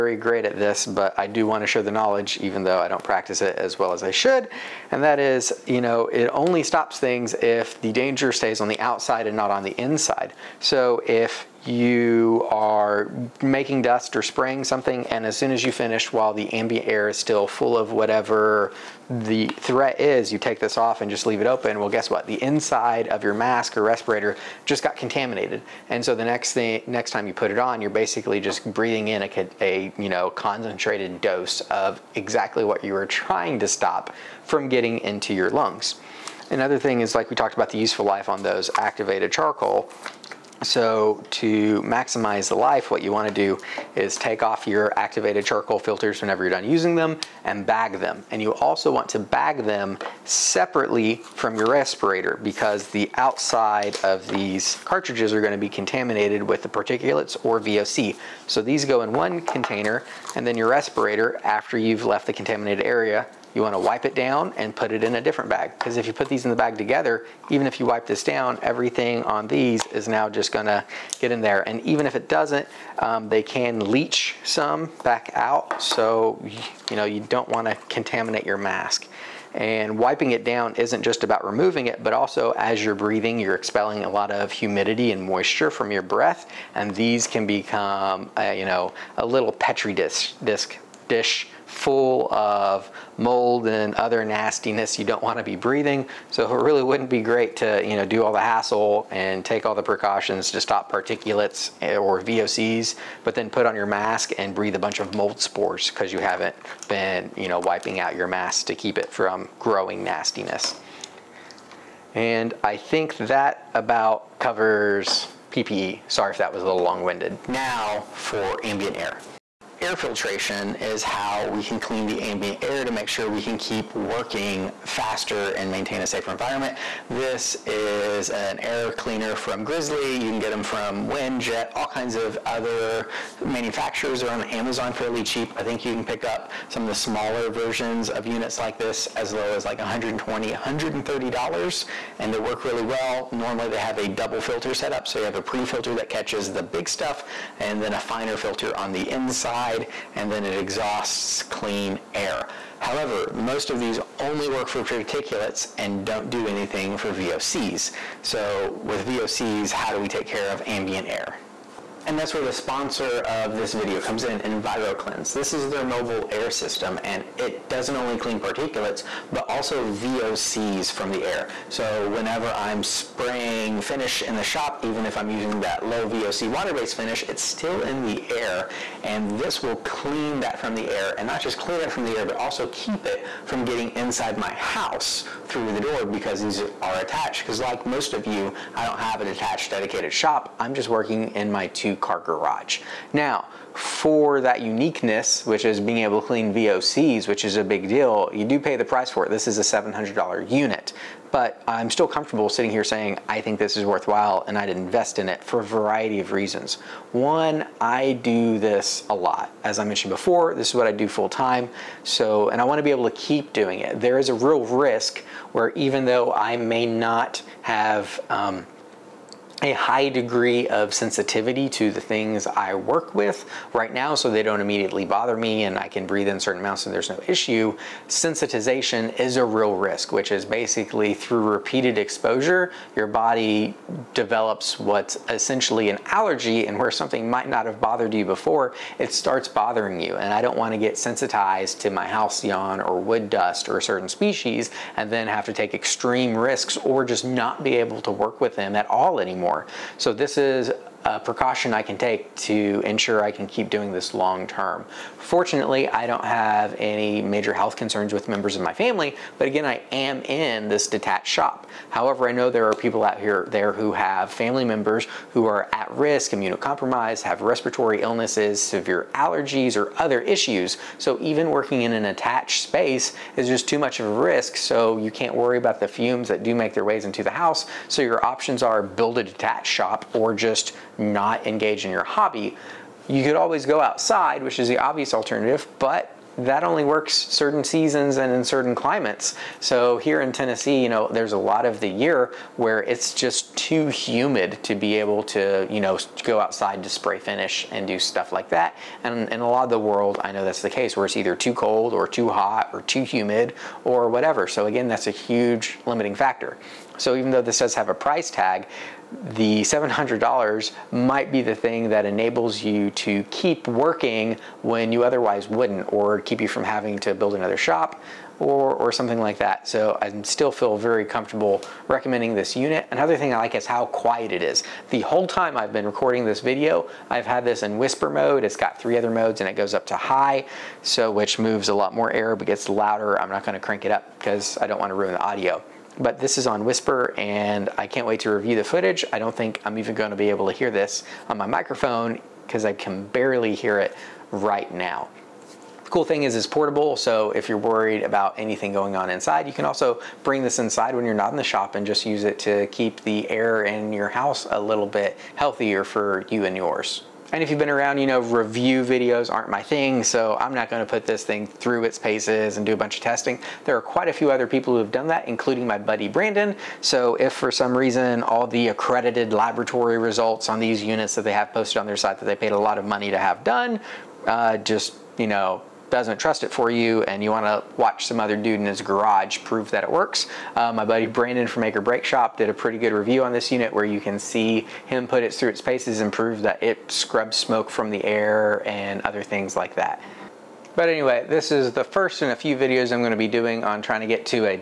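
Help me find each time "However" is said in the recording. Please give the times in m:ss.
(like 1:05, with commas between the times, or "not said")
2:32, 4:21.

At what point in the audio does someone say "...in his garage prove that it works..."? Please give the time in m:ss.
6:18.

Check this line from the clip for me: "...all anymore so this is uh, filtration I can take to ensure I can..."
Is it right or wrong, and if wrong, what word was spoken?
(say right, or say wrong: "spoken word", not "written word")
wrong: "precaution", not "filtration".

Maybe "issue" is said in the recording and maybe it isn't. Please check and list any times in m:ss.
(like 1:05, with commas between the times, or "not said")
3:47, 4:30.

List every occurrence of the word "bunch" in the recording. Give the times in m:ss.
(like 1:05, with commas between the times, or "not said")
1:44, 6:02.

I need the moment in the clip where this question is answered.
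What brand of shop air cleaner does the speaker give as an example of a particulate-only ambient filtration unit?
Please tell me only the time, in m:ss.
2:09.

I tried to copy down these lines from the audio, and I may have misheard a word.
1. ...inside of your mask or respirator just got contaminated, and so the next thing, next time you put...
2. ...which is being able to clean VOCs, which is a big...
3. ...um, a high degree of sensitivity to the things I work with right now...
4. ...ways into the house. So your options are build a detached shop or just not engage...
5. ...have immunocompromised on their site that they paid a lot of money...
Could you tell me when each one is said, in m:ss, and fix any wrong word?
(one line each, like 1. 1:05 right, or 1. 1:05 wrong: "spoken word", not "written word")
1. 0:22 right
2. 3:15 right
3. 3:38 right
4. 4:36 right
5. 6:11 wrong: "posted", not "immunocompromised".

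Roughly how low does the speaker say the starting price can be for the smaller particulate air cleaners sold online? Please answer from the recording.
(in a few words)
$120.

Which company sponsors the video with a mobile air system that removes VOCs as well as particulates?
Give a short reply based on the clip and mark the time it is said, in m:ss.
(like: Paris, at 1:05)
EnviroKlenz, at 2:44.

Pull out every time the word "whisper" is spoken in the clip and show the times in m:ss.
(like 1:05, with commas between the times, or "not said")
5:27, 5:36.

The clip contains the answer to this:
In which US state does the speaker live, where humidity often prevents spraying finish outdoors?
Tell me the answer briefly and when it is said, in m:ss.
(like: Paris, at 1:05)
Tennessee, at 4:50.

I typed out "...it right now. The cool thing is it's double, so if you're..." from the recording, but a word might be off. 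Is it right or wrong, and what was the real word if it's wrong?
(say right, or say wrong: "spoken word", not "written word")
wrong: "portable", not "double".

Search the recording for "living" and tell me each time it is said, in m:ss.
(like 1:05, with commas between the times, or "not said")
not said.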